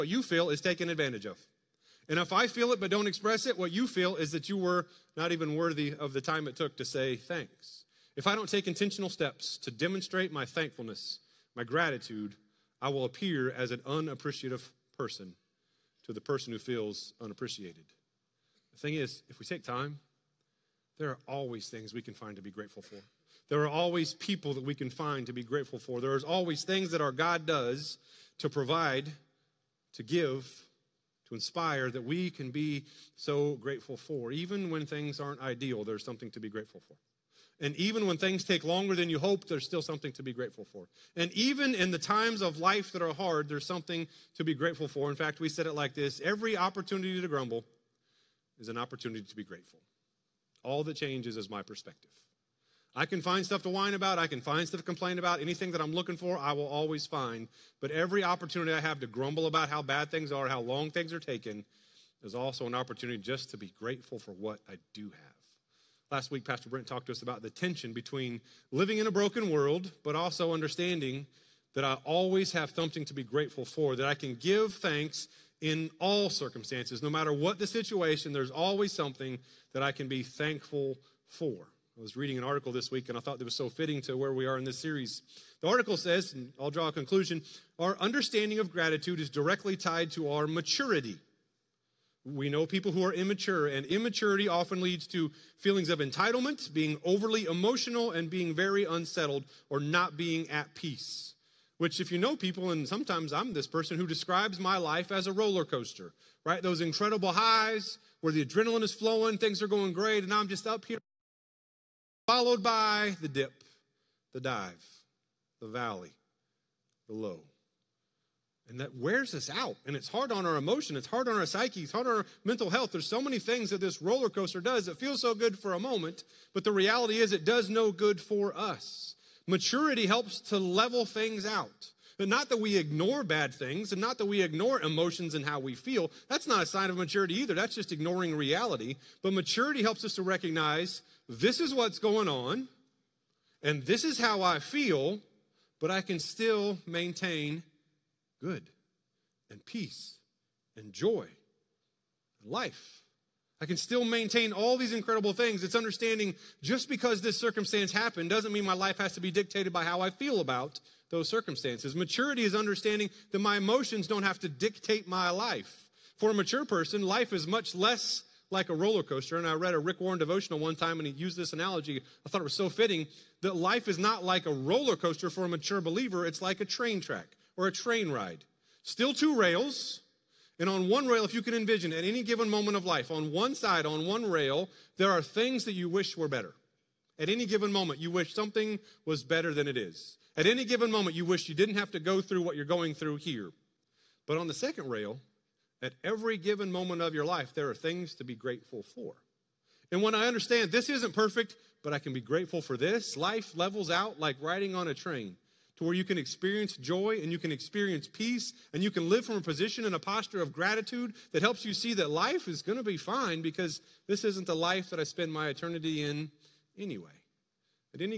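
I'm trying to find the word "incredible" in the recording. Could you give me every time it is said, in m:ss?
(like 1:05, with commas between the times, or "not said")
1:46, 2:34.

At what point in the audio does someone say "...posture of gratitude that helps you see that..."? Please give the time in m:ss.
3:29.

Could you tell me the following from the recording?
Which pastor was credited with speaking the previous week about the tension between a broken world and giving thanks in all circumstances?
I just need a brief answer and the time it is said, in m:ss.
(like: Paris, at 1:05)
Pastor Brent, at 1:06.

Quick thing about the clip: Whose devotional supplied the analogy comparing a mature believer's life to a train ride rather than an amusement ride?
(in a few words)
Rick Warren.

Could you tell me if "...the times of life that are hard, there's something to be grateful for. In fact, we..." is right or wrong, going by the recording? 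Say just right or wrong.
right.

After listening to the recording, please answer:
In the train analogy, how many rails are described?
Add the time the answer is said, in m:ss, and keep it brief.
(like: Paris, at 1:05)
2, at 2:59.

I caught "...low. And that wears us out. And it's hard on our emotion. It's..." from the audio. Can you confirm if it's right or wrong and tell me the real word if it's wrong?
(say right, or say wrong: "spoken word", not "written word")
right.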